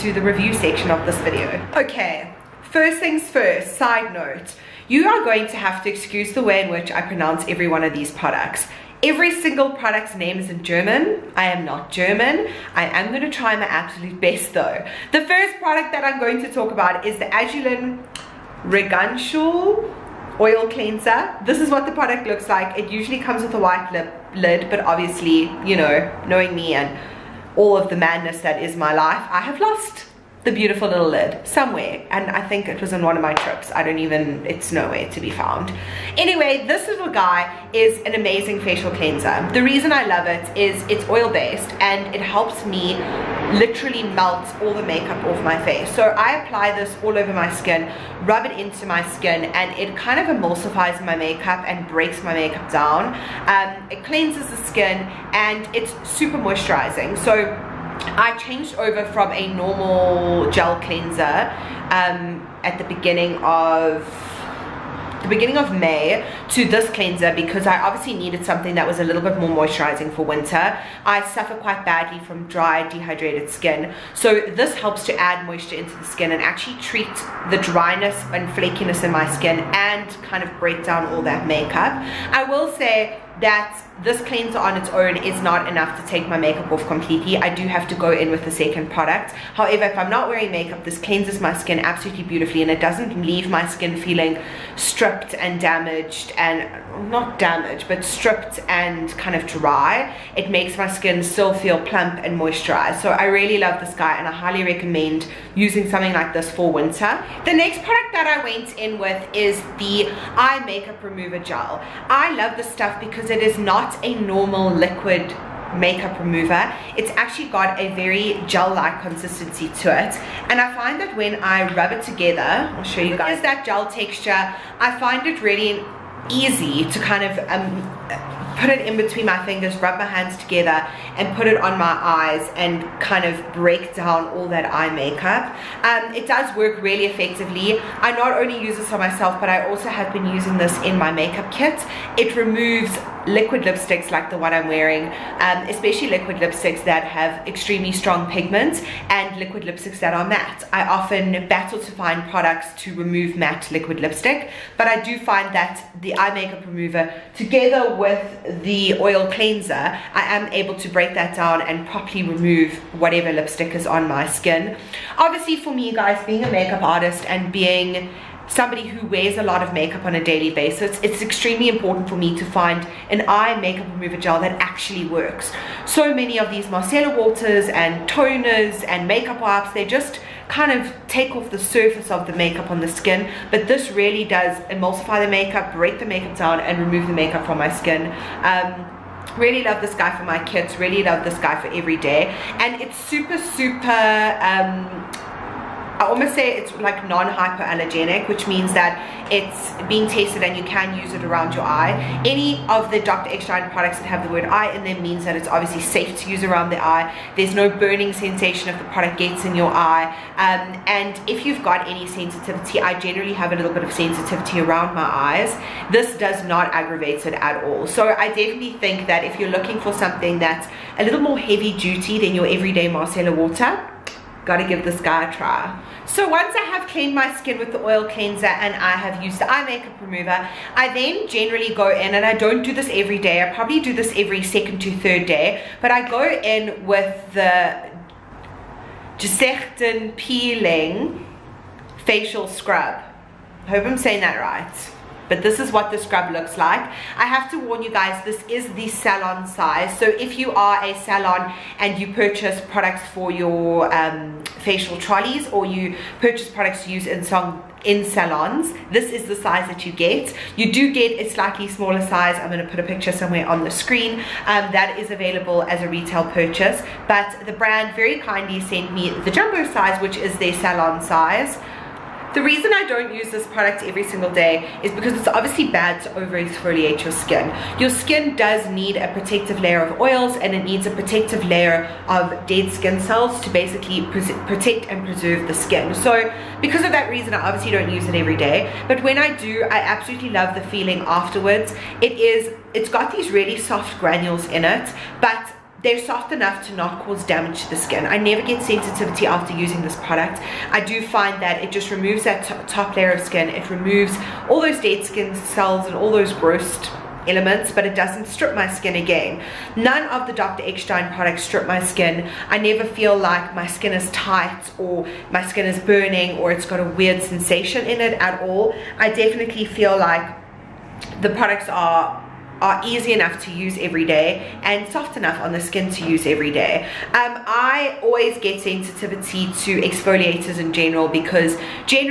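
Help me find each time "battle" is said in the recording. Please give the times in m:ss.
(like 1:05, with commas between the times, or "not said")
2:31.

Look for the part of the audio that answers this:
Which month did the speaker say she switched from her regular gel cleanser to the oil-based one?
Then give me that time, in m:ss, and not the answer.
1:05.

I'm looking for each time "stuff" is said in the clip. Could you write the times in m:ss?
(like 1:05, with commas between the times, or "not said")
1:52.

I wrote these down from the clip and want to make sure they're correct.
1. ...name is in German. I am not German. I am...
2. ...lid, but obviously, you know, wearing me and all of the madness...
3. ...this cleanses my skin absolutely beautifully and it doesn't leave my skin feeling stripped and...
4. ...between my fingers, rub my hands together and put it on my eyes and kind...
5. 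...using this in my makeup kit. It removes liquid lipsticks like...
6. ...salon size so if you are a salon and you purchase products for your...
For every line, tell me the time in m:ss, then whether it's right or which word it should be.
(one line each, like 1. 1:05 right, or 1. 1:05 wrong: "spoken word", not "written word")
1. 0:10 right
2. 0:24 wrong: "knowing", not "wearing"
3. 1:30 right
4. 2:08 right
5. 2:20 right
6. 4:08 right.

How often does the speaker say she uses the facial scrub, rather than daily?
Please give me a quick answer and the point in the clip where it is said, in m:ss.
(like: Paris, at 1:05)
every second to third day, at 3:54.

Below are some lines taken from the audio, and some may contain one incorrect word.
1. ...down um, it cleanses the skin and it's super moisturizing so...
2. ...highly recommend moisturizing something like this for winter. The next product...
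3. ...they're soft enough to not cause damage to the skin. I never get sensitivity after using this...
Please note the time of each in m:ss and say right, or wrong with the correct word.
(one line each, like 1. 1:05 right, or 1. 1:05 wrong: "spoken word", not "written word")
1. 0:52 right
2. 1:44 wrong: "using", not "moisturizing"
3. 4:55 right.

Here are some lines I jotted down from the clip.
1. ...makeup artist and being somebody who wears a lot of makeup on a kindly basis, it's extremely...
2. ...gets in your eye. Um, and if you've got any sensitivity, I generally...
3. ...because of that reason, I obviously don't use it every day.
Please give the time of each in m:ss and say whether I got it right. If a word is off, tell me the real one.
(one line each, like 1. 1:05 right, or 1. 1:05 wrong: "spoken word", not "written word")
1. 2:46 wrong: "daily", not "kindly"
2. 3:29 right
3. 4:46 right.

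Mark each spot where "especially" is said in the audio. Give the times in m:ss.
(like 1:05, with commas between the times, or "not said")
2:25.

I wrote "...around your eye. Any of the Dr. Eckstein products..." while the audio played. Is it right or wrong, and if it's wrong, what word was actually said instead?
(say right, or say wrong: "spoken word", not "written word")
right.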